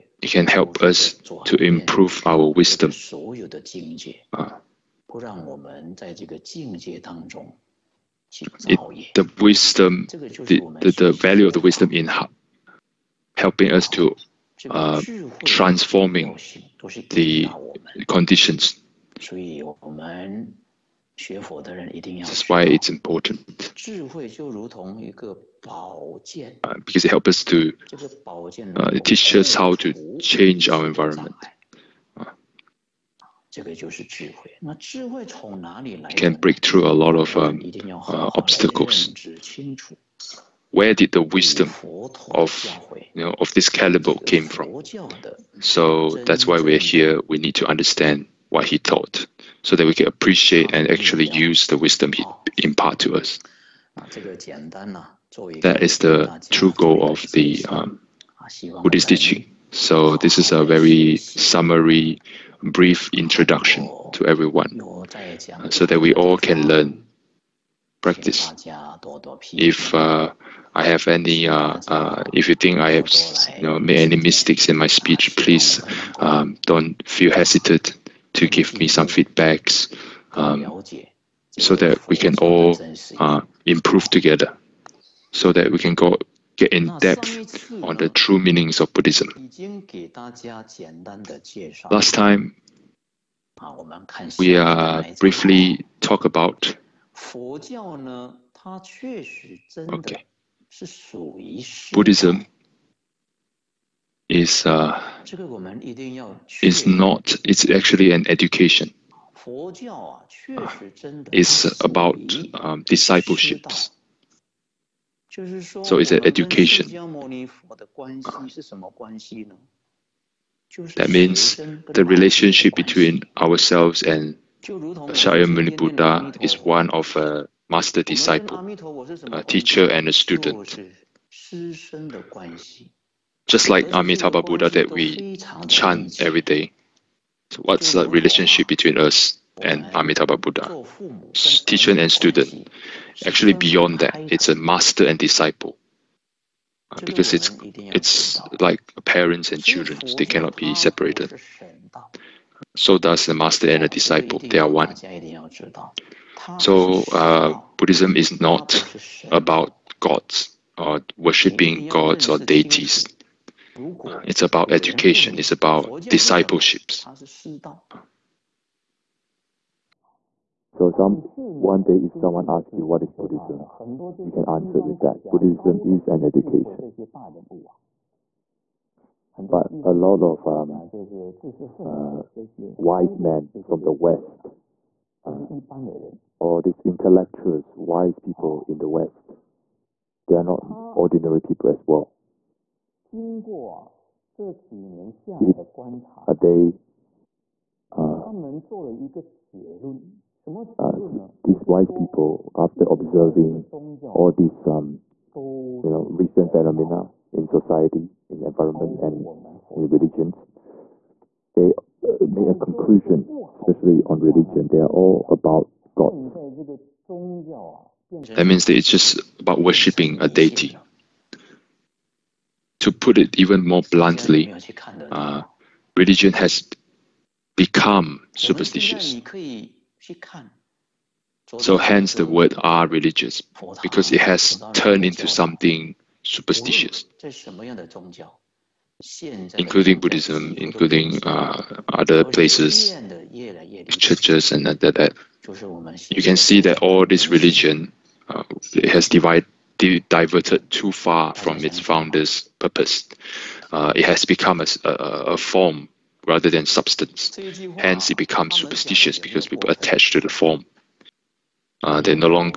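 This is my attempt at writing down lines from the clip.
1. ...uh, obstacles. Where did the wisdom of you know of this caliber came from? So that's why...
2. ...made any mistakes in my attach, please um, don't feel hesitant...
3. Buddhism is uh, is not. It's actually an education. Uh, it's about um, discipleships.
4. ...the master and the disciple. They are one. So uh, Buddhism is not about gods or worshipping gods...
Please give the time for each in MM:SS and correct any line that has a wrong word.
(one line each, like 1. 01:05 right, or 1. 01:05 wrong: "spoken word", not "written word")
1. 00:37 right
2. 01:13 wrong: "speech", not "attach"
3. 01:41 right
4. 02:33 right.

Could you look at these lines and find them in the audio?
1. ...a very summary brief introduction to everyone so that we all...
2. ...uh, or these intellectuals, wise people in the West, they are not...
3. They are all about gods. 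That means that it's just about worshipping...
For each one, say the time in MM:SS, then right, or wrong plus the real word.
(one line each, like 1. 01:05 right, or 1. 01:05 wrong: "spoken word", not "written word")
1. 01:00 right
2. 03:05 right
3. 03:34 right.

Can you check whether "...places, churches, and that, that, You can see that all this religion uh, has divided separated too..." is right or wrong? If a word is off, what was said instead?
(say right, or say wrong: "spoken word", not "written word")
wrong: "diverted", not "separated".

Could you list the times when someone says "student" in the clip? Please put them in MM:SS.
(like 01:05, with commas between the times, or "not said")
02:10, 02:22.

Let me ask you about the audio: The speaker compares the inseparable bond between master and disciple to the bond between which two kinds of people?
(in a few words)
Parents and children.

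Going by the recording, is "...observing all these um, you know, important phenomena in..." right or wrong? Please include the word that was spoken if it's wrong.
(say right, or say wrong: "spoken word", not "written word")
wrong: "recent", not "important".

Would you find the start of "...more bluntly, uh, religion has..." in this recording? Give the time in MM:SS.
03:43.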